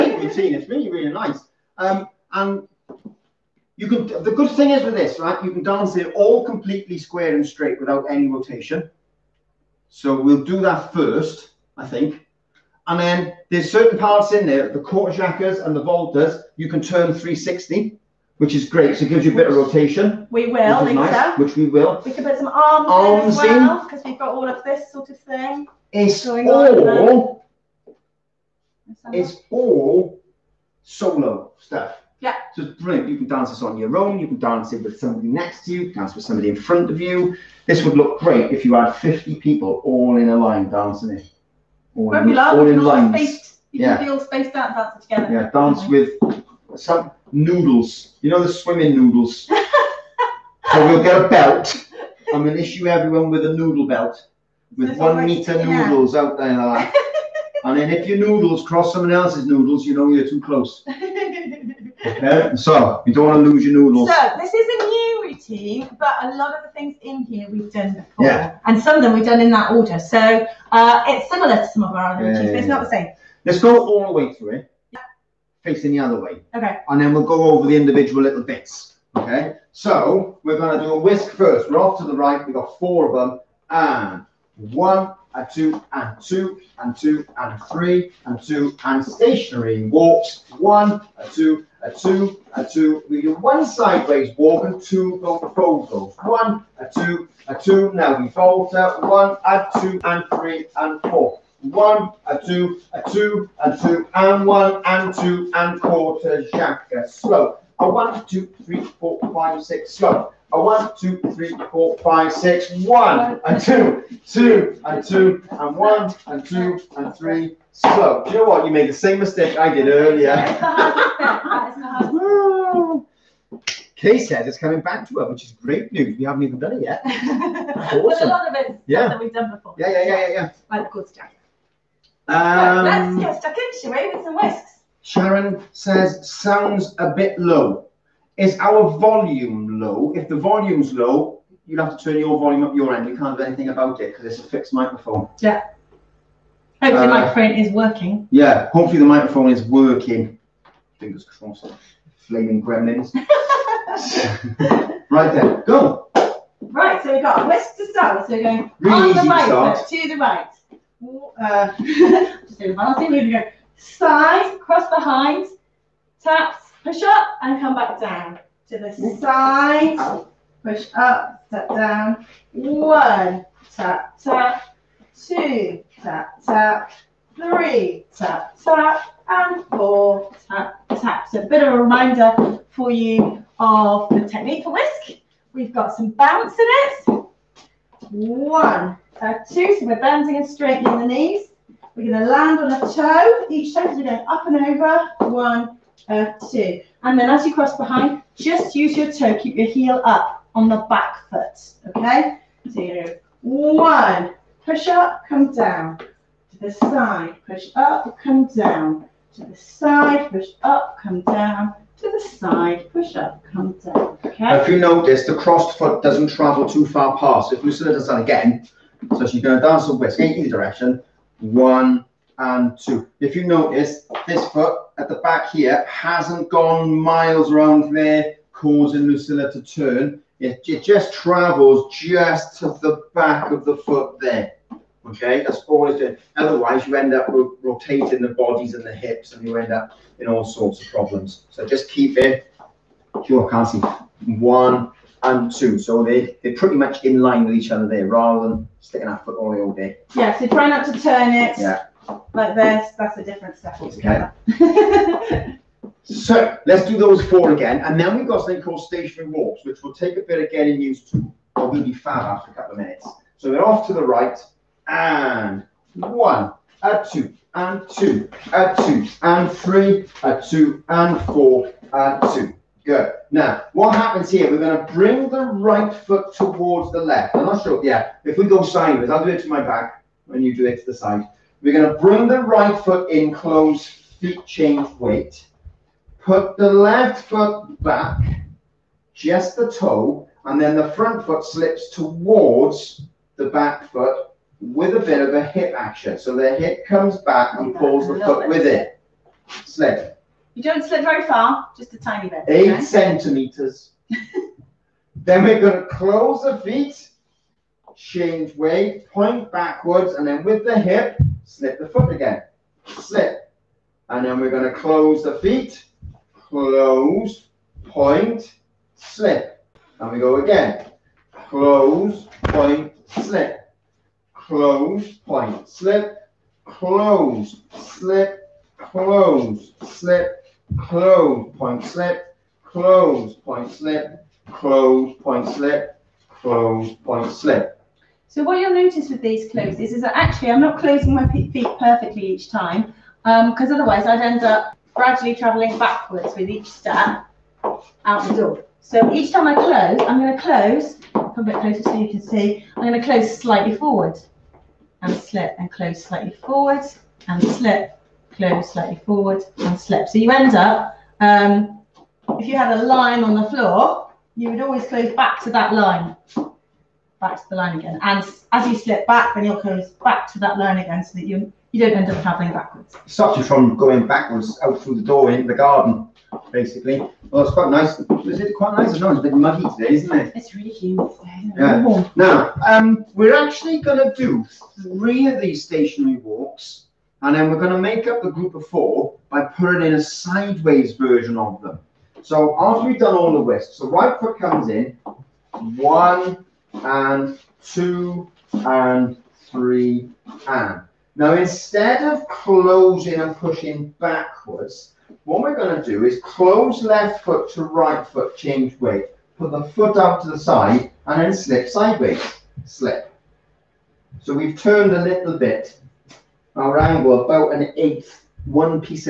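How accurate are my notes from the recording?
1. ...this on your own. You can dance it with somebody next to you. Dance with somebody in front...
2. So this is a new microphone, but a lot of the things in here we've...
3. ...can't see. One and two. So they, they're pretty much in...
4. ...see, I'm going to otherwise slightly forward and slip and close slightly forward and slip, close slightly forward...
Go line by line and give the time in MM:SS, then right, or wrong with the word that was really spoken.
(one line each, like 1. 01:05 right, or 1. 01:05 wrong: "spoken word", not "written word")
1. 00:33 right
2. 01:04 wrong: "routine", not "microphone"
3. 04:03 right
4. 05:52 wrong: "close", not "otherwise".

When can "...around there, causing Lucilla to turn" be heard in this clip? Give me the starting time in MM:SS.
03:47.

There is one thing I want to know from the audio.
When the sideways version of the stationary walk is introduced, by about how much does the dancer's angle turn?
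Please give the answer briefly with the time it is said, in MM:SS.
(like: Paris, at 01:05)
an eighth, at 06:57.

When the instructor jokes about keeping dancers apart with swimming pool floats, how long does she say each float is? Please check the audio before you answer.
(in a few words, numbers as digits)
1 meter.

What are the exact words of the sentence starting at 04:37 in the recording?
I'm not sure, yeah, if we go sideways, I'll do it to my back, and you do it to the side.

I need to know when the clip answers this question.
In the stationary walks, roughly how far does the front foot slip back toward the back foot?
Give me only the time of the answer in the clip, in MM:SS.
05:02.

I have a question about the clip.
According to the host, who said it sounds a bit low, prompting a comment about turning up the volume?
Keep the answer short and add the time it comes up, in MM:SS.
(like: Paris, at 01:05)
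Sharon, at 02:15.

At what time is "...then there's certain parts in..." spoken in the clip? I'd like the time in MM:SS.
00:12.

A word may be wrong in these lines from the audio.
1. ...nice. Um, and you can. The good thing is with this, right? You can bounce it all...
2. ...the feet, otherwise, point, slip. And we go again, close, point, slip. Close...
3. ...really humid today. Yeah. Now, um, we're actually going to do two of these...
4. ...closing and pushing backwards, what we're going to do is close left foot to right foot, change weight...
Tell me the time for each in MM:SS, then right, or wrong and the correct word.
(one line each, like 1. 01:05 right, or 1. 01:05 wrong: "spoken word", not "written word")
1. 00:01 wrong: "dance", not "bounce"
2. 05:15 wrong: "close", not "otherwise"
3. 06:20 wrong: "three", not "two"
4. 06:42 right.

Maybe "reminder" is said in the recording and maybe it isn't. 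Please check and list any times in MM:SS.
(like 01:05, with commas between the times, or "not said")
03:01.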